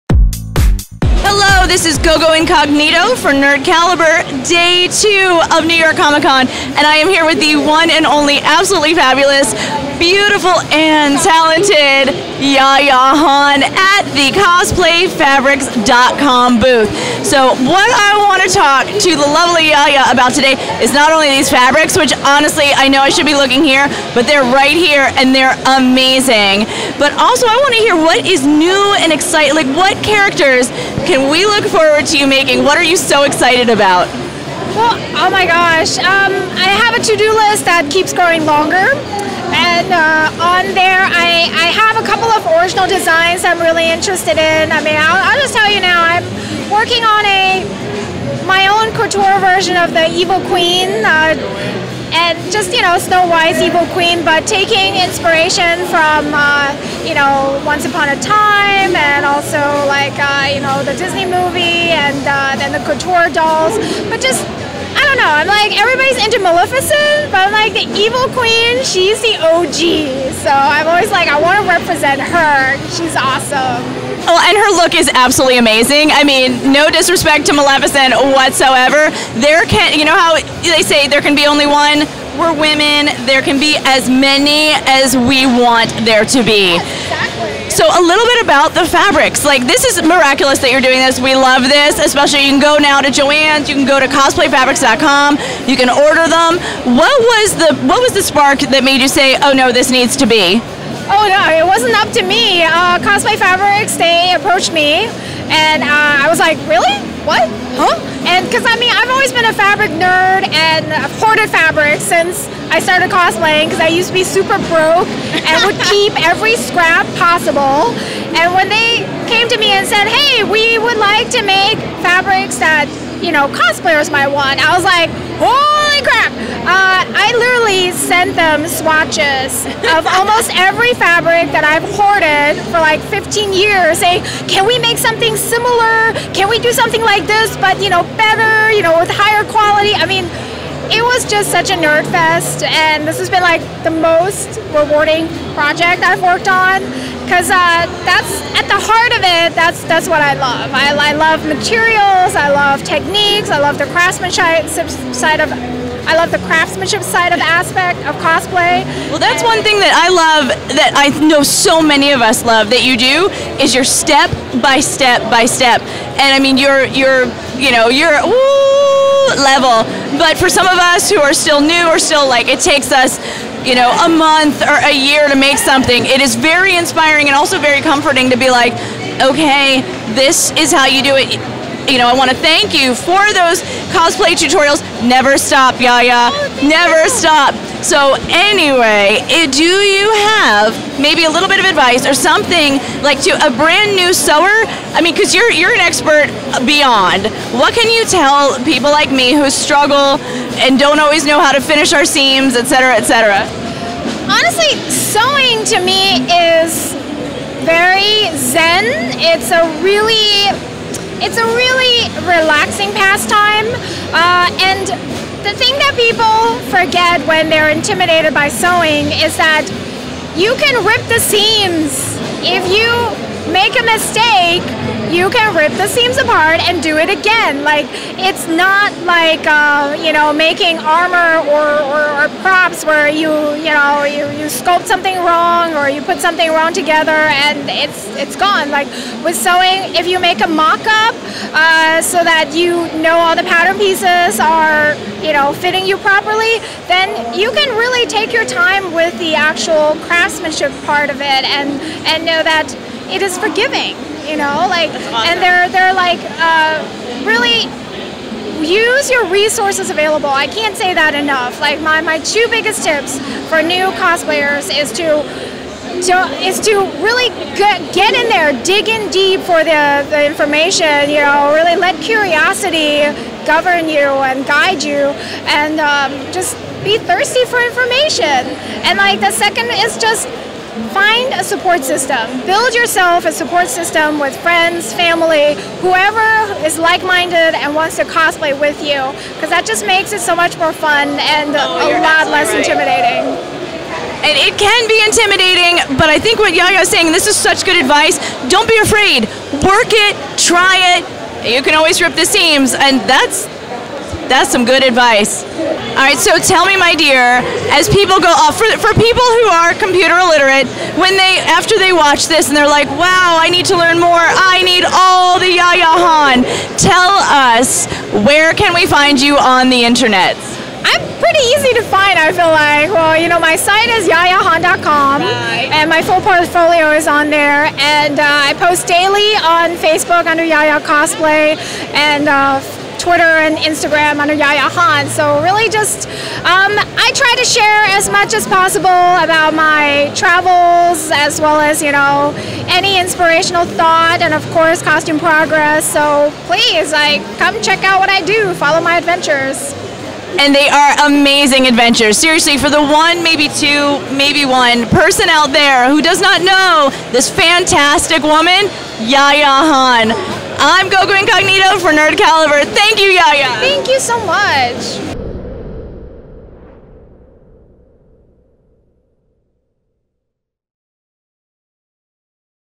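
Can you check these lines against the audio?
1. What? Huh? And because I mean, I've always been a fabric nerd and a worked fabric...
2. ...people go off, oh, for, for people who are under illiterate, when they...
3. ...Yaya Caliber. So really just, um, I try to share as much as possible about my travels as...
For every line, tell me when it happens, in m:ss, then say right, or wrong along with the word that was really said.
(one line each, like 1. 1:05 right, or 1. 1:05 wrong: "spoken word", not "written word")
1. 1:47 wrong: "hoarded", not "worked"
2. 5:07 wrong: "computer", not "under"
3. 5:34 wrong: "Han", not "Caliber".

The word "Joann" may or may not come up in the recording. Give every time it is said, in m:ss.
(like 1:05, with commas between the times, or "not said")
1:33.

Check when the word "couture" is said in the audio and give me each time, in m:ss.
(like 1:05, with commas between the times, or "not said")
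0:48, 1:02.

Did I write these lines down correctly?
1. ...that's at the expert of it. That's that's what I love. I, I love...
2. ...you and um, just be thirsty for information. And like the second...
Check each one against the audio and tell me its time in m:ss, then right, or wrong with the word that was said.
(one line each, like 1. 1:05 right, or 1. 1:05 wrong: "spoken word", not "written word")
1. 2:28 wrong: "heart", not "expert"
2. 4:34 right.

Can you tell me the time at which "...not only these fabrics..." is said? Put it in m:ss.
0:20.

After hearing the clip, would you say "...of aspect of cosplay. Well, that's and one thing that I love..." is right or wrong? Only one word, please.
right.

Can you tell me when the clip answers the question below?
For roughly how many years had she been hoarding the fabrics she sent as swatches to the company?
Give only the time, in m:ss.
2:13.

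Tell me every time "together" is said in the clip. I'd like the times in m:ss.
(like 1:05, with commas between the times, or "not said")
3:56.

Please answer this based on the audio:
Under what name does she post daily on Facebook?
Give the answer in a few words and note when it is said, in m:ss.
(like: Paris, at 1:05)
Yaya Cosplay, at 5:30.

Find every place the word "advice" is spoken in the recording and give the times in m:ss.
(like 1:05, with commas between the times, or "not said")
3:11, 4:57, 5:04.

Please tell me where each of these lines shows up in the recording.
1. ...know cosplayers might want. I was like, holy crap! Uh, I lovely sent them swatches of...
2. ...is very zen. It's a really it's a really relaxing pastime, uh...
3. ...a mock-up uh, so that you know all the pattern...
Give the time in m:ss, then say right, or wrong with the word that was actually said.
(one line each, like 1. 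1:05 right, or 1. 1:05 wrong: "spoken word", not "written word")
1. 2:03 wrong: "literally", not "lovely"
2. 3:26 right
3. 4:00 right.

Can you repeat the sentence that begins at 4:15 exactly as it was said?
and they're they're like uh, really use your resources available.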